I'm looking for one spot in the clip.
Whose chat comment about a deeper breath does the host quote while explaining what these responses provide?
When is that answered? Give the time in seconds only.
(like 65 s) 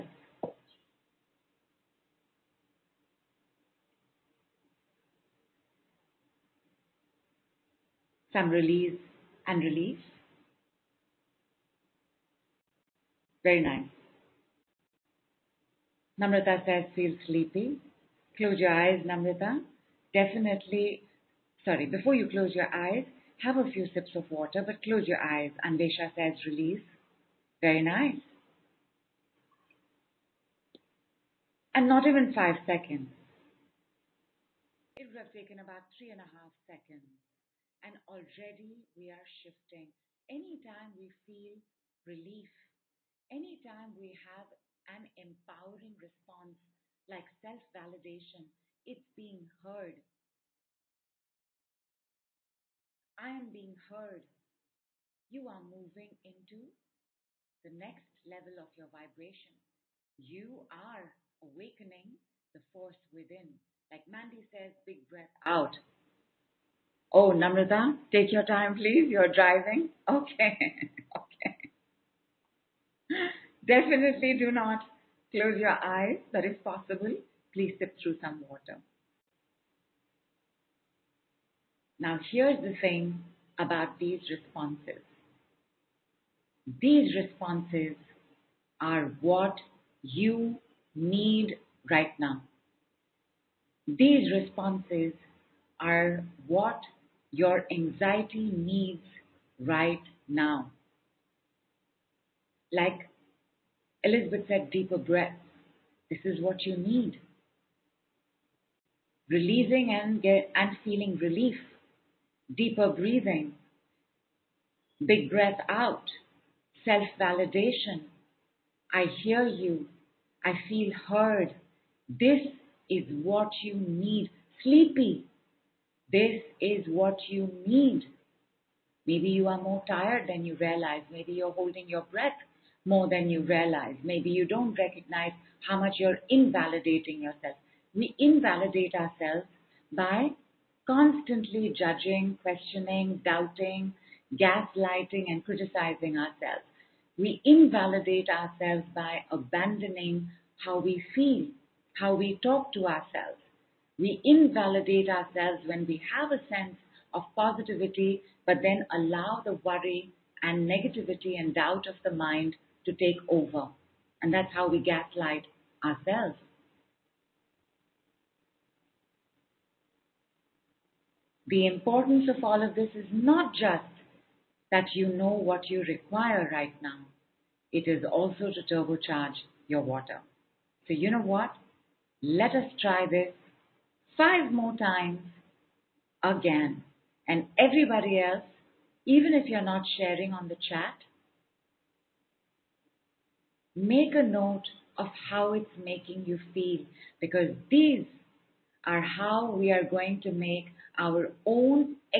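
104 s.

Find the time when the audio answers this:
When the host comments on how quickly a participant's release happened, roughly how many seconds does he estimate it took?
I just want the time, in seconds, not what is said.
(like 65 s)
35 s.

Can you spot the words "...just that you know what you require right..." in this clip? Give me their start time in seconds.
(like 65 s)
173 s.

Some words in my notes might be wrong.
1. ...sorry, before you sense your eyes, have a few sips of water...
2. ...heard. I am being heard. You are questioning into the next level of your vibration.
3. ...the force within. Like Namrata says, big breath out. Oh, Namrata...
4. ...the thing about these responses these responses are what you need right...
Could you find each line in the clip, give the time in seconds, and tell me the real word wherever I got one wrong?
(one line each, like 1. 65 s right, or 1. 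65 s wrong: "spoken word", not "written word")
1. 21 s wrong: "close", not "sense"
2. 49 s wrong: "moving", not "questioning"
3. 62 s wrong: "Mandy", not "Namrata"
4. 82 s right.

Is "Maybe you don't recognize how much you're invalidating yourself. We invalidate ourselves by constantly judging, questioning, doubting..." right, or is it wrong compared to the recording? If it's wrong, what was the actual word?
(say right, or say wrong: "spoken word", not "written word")
right.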